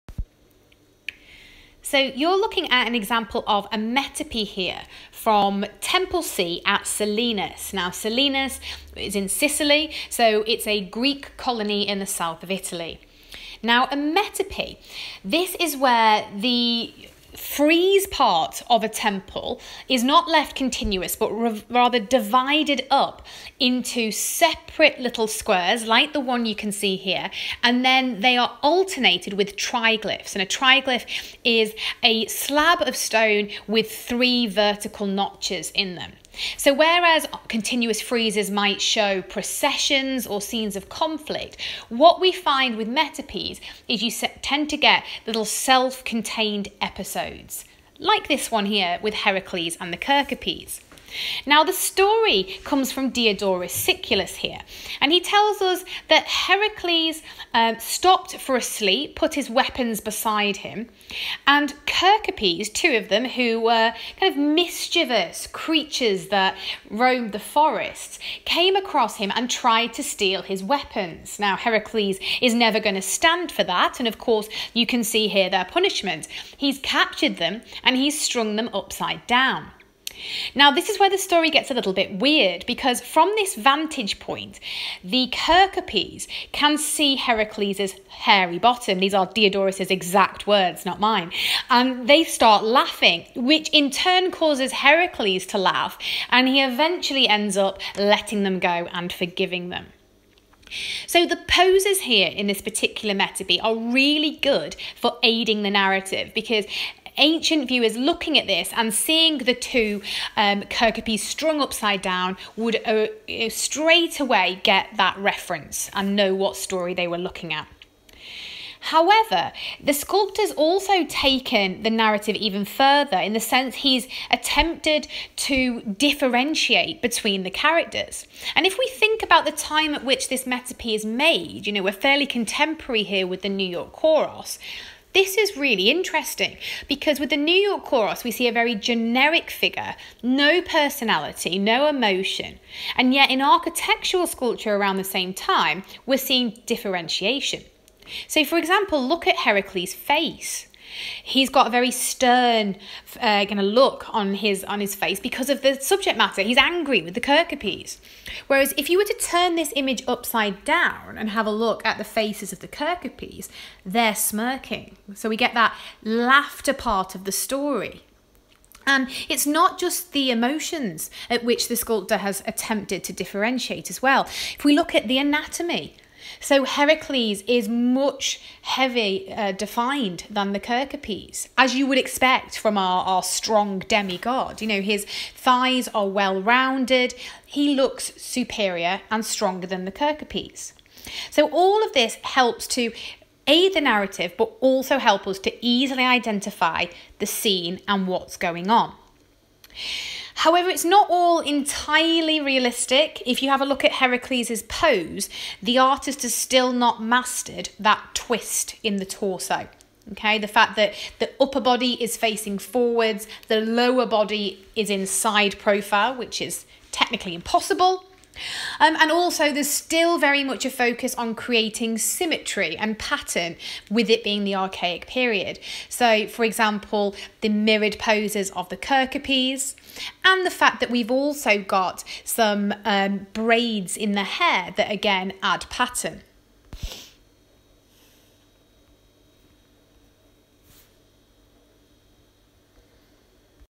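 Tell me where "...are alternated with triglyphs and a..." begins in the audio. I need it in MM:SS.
00:28.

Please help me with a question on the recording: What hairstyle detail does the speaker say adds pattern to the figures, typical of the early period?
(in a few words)
Braids.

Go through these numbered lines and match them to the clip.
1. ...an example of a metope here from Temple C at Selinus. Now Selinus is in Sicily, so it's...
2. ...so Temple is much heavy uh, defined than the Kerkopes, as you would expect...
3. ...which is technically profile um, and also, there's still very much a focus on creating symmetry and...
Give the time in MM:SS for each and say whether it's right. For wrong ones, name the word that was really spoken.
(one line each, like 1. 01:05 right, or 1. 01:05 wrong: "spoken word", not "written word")
1. 00:02 right
2. 02:56 wrong: "Heracles", not "Temple"
3. 03:36 wrong: "impossible", not "profile".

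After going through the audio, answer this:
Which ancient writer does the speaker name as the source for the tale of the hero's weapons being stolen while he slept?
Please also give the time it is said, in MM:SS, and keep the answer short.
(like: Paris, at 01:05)
Diodorus Siculus, at 00:53.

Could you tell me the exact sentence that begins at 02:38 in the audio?
Whereas if you were to turn this image upside down and have a look at the faces of the Kerkopes, they're smirking.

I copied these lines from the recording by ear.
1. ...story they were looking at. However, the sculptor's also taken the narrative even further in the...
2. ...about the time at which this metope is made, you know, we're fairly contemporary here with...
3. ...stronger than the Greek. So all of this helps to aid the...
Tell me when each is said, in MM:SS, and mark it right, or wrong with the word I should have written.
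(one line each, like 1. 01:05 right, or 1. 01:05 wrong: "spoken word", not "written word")
1. 01:56 right
2. 02:09 right
3. 03:09 wrong: "Kerkopes", not "Greek".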